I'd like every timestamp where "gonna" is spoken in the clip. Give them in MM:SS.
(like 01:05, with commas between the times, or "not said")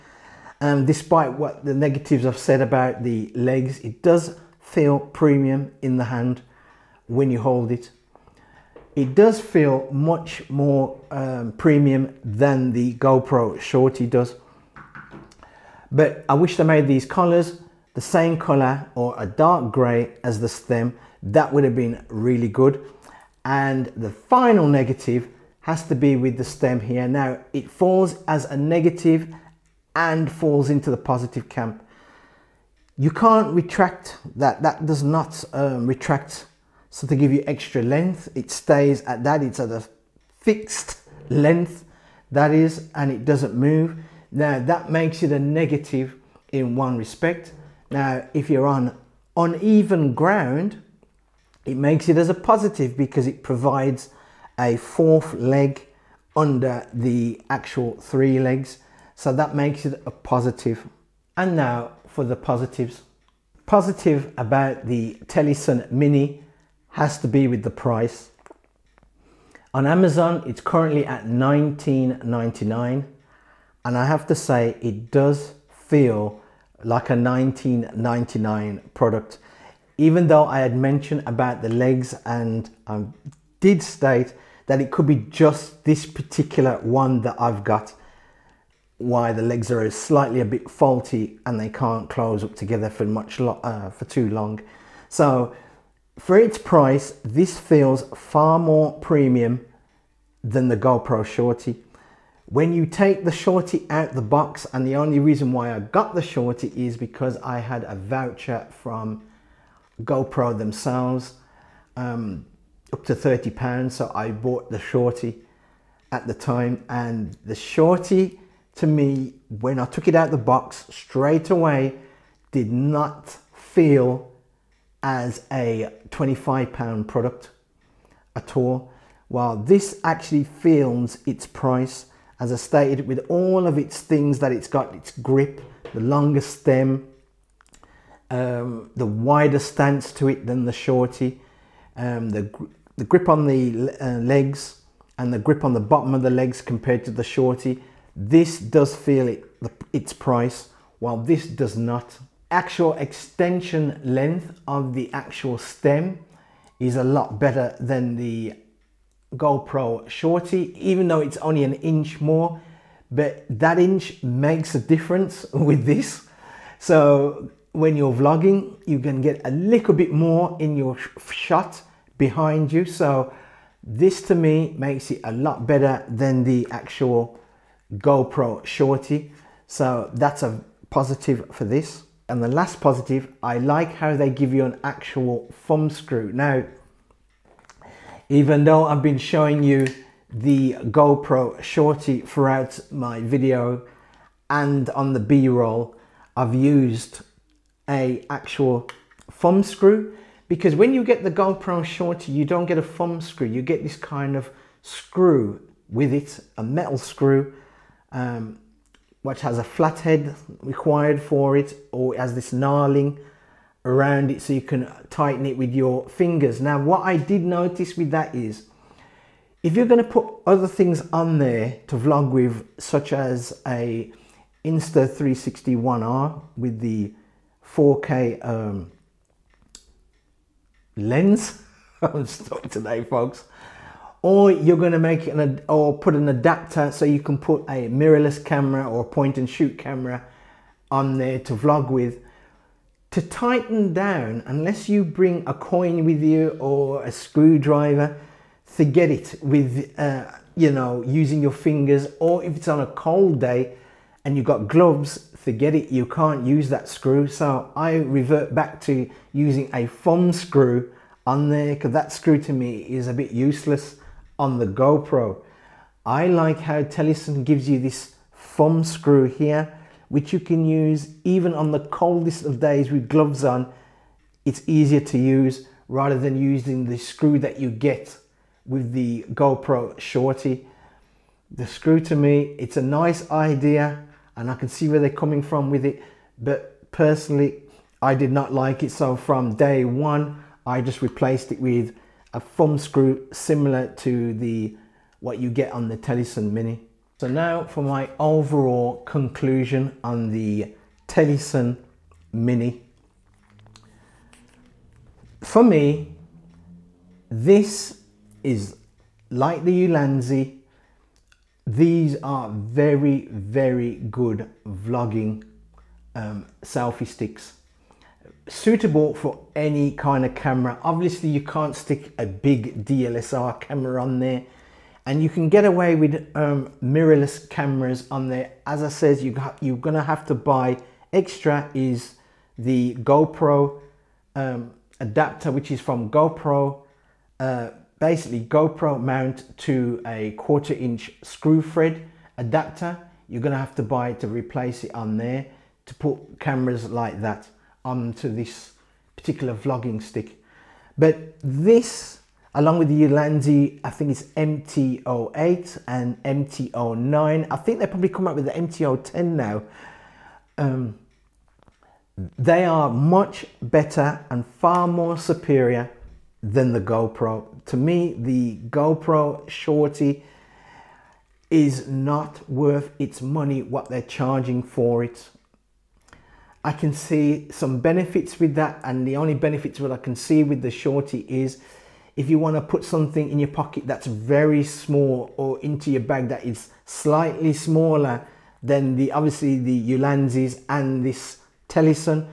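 03:39, 05:29, 05:43.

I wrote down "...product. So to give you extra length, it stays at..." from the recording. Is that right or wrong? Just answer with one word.
wrong.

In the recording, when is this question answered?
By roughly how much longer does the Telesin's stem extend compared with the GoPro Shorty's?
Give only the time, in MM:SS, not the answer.
02:41.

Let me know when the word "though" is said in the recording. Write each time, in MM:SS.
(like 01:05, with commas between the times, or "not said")
01:20, 02:41, 03:08.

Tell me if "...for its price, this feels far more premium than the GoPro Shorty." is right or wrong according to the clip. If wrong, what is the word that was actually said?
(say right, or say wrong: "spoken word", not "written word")
right.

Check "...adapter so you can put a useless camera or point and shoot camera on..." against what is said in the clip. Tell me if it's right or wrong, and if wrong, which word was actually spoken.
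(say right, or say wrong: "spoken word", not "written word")
wrong: "mirrorless", not "useless".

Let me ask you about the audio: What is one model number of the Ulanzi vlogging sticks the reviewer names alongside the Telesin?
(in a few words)
MT-08.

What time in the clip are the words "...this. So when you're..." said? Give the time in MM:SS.
02:45.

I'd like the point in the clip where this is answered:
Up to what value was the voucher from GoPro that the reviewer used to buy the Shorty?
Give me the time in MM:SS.
01:52.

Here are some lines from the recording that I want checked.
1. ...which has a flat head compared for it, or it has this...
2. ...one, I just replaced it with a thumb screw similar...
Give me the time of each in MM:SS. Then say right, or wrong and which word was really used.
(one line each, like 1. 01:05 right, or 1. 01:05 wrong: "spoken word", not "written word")
1. 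03:29 wrong: "required", not "compared"
2. 04:49 right.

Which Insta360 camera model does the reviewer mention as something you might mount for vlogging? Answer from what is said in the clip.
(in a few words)
One R.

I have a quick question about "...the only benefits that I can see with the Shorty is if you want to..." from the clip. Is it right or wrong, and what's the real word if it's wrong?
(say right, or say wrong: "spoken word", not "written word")
right.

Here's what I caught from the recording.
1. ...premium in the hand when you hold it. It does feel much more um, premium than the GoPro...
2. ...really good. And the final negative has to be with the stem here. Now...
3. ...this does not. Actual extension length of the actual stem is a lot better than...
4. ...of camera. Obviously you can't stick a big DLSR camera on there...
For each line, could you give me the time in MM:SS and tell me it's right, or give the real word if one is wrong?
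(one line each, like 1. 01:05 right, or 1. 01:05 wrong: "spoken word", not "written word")
1. 00:04 right
2. 00:22 right
3. 02:31 right
4. 05:20 right.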